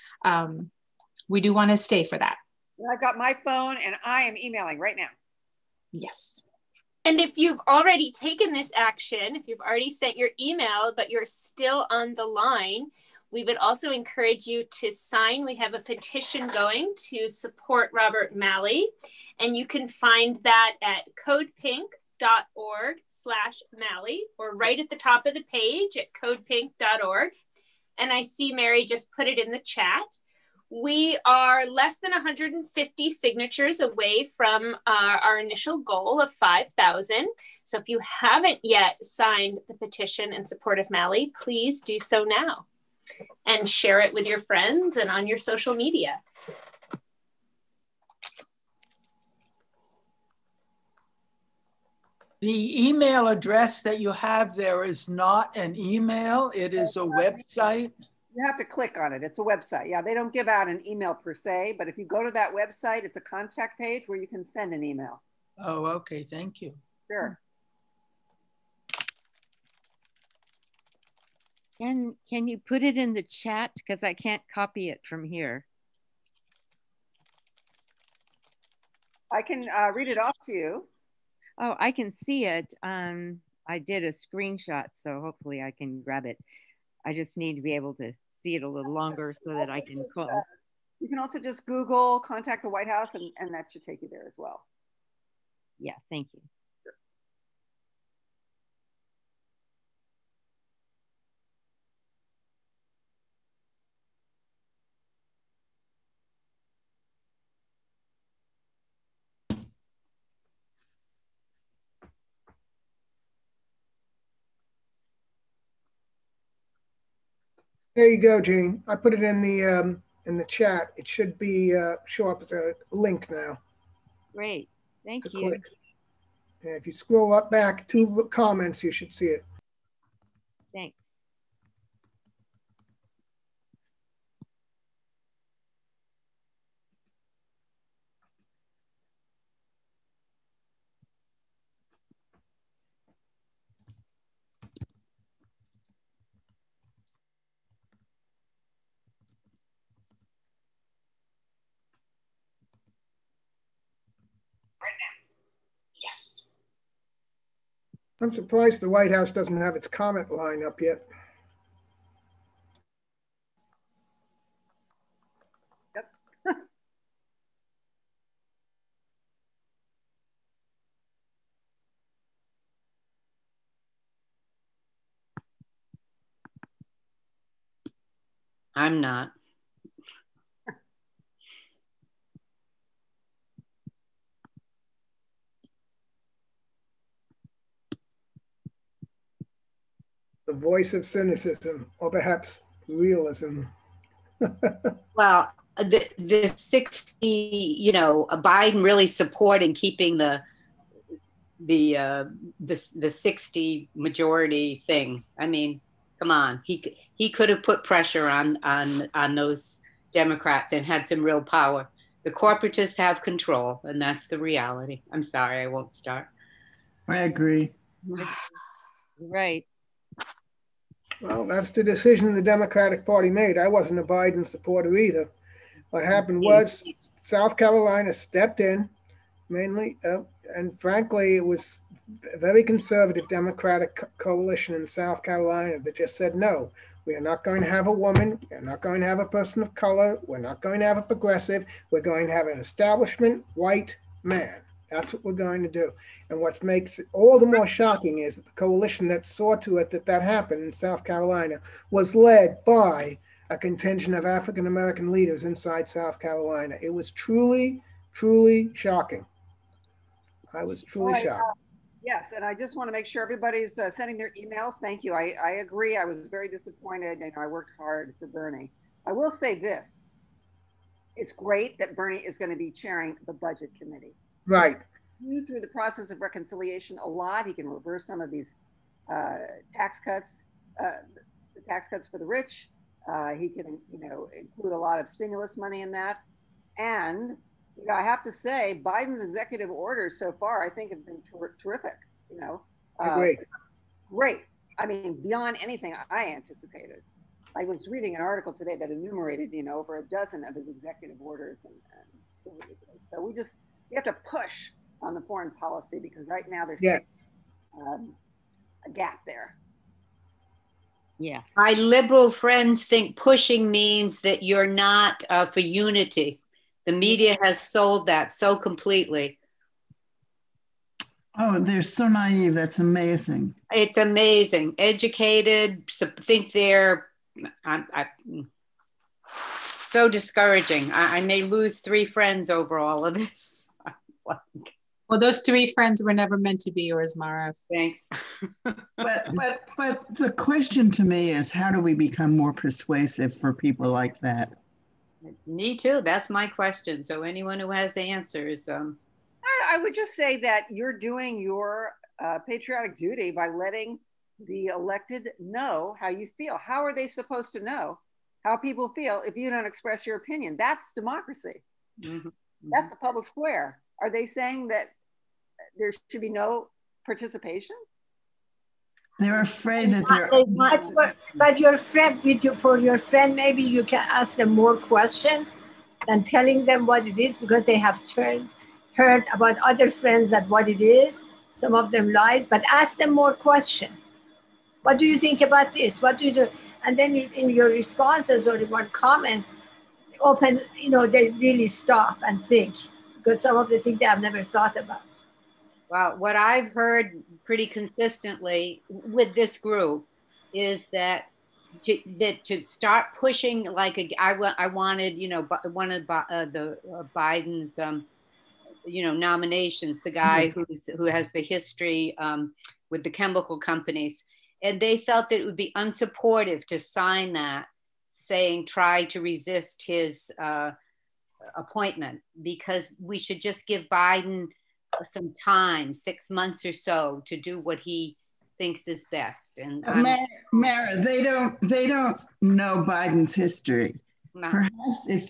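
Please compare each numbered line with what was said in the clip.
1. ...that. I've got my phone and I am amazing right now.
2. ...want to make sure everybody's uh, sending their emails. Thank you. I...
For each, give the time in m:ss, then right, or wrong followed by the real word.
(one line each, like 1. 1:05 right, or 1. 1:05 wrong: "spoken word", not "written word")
1. 0:02 wrong: "emailing", not "amazing"
2. 4:22 right.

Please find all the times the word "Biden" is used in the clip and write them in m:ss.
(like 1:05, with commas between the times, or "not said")
3:18, 3:44, 4:48, 6:47, 7:03, 7:12.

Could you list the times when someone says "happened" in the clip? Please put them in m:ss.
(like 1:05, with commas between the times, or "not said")
3:46, 4:10.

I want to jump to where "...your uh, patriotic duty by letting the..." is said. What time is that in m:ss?
5:51.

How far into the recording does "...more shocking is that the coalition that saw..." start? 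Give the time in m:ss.
4:07.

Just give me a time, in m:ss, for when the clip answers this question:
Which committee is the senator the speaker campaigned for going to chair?
4:33.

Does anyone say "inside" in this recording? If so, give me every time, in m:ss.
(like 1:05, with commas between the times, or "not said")
4:15.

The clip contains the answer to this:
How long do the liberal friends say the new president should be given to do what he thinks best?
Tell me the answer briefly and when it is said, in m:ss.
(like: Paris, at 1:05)
6 months, at 7:05.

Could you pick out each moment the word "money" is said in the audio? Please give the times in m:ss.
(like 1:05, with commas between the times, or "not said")
4:45.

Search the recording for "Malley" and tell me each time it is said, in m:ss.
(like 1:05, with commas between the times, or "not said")
0:18, 0:23, 0:40.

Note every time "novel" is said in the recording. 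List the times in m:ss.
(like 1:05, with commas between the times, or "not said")
not said.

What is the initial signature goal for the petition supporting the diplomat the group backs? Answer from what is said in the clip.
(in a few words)
5,000.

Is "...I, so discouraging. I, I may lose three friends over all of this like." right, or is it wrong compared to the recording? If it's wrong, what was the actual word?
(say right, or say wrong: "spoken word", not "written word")
right.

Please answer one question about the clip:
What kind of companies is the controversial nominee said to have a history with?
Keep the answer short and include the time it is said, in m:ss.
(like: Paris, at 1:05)
chemical companies, at 6:53.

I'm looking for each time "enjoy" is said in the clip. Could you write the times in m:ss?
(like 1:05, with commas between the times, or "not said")
not said.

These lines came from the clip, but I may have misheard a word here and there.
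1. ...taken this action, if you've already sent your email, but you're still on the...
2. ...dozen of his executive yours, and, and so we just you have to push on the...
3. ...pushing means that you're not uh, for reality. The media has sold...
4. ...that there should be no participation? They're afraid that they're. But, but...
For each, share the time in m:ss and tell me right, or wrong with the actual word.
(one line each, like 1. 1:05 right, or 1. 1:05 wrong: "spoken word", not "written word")
1. 0:08 right
2. 5:00 wrong: "orders", not "yours"
3. 5:13 wrong: "unity", not "reality"
4. 6:04 right.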